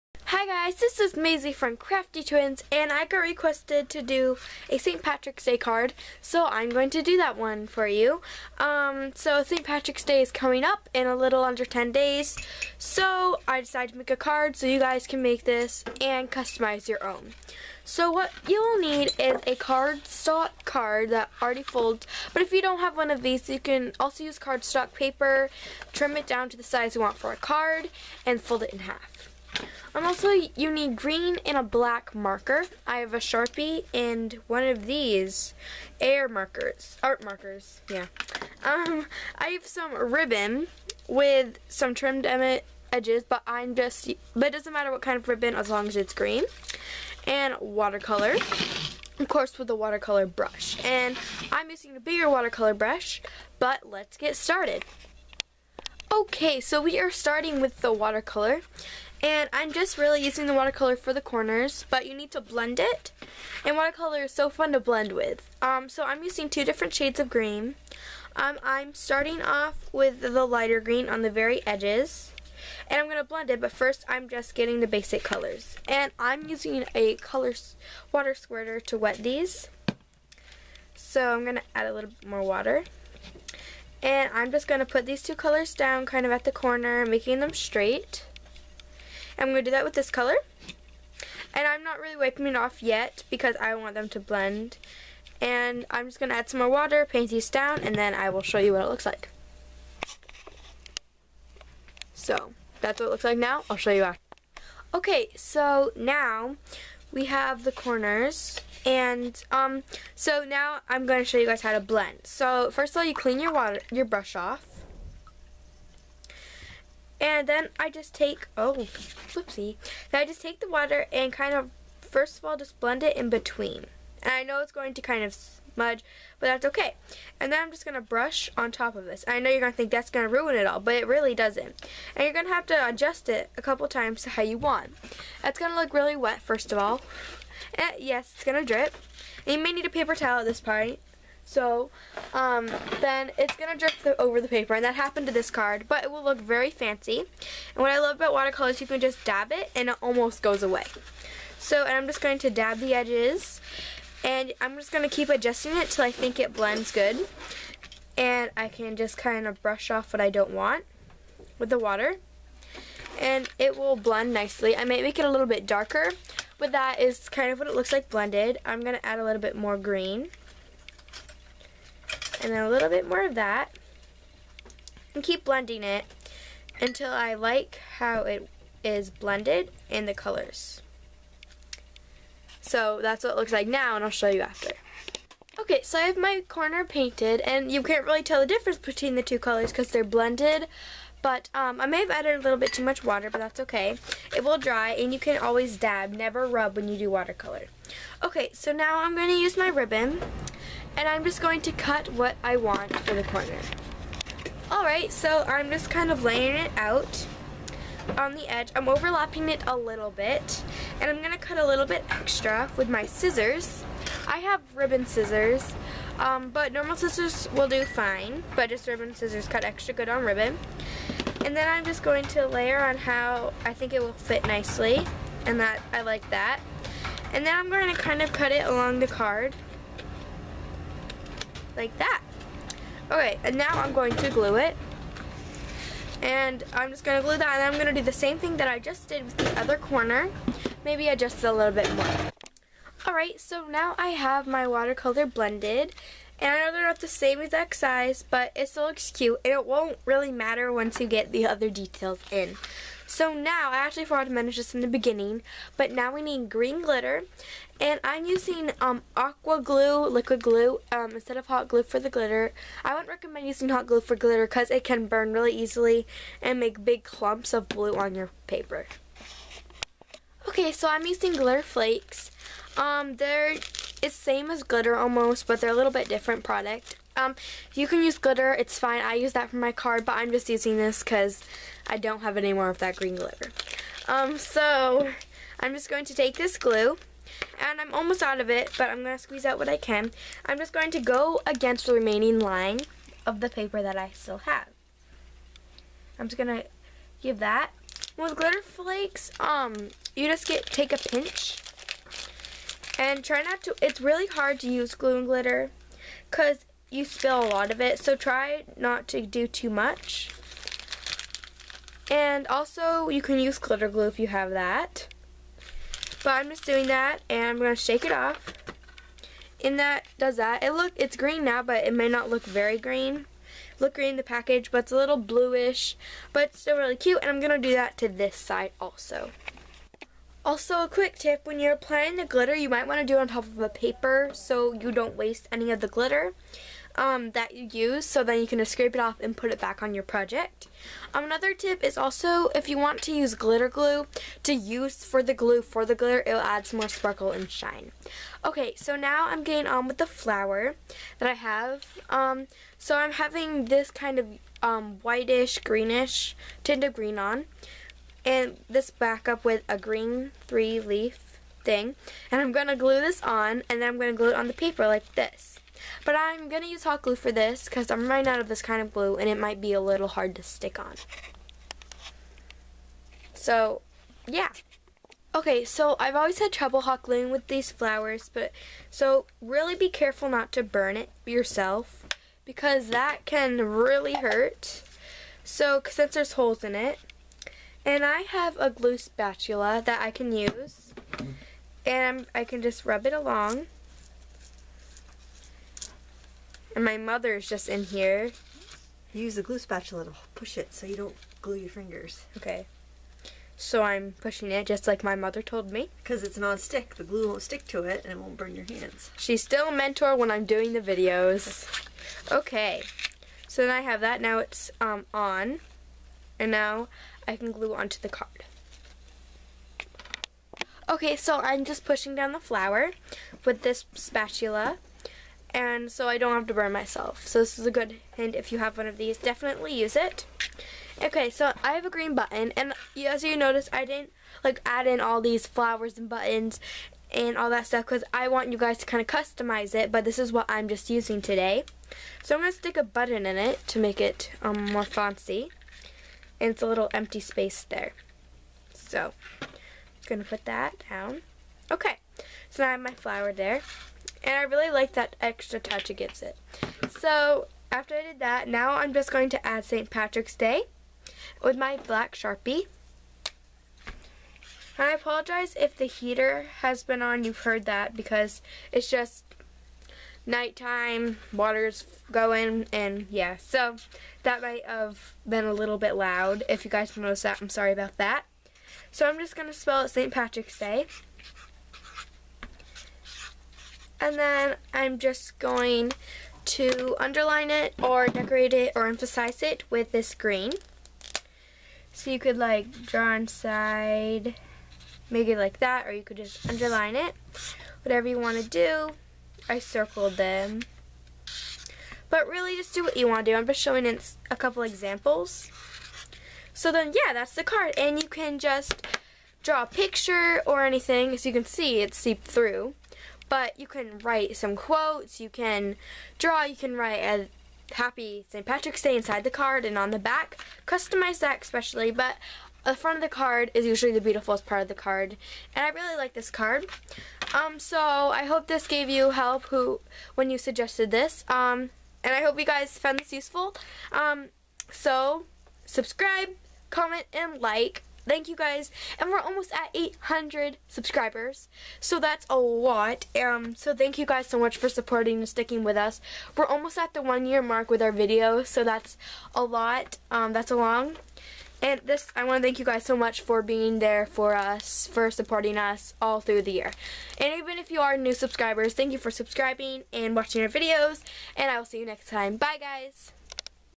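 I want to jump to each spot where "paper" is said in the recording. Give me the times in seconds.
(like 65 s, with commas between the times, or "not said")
24 s, 139 s, 144 s, 268 s, 293 s, 333 s, 364 s.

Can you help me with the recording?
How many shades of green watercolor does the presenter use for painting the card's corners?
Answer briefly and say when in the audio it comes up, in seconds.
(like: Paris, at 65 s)
2, at 66 s.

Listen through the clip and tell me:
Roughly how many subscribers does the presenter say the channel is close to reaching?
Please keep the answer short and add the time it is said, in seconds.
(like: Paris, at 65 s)
800, at 539 s.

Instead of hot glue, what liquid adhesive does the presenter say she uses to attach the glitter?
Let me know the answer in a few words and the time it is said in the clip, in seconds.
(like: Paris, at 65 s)
aqua glue, at 259 s.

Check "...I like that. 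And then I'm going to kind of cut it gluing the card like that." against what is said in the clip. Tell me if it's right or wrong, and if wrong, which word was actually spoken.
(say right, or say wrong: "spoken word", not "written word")
wrong: "along", not "gluing".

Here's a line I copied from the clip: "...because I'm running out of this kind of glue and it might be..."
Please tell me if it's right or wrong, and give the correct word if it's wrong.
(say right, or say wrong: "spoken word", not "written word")
right.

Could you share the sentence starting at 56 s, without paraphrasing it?
Okay, so we are starting with the watercolor.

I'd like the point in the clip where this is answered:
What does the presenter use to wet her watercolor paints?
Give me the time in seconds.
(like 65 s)
77 s.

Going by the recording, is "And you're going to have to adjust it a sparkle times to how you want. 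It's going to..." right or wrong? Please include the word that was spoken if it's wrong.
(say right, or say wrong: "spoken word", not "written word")
wrong: "couple", not "sparkle".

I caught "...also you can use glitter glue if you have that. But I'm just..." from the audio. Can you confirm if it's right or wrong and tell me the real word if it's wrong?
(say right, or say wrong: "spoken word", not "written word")
right.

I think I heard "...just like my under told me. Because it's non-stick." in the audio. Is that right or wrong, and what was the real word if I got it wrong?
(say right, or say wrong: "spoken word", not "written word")
wrong: "mother", not "under".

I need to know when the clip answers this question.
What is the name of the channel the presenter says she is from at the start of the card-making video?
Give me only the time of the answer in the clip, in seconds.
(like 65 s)
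1 s.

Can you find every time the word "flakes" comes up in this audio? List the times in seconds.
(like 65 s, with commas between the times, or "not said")
271 s, 298 s.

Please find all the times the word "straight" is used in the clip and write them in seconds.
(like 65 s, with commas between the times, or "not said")
87 s.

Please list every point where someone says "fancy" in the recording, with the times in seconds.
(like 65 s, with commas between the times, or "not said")
146 s, 444 s.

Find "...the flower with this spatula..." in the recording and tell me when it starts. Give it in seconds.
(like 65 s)
422 s.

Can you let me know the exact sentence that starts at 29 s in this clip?
Um, also, you need green and a black marker.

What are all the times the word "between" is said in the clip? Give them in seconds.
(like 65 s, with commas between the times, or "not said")
123 s, 188 s.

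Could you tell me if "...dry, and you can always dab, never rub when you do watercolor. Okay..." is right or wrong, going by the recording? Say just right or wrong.
right.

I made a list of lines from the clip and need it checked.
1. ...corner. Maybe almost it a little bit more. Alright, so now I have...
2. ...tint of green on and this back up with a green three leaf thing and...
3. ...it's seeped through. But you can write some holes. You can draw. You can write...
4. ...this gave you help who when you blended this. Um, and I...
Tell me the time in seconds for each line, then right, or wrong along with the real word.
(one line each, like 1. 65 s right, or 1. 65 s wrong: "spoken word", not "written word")
1. 239 s wrong: "adjust", not "almost"
2. 356 s right
3. 511 s wrong: "quotes", not "holes"
4. 528 s wrong: "suggested", not "blended".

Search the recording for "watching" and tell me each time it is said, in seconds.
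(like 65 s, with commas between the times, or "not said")
560 s.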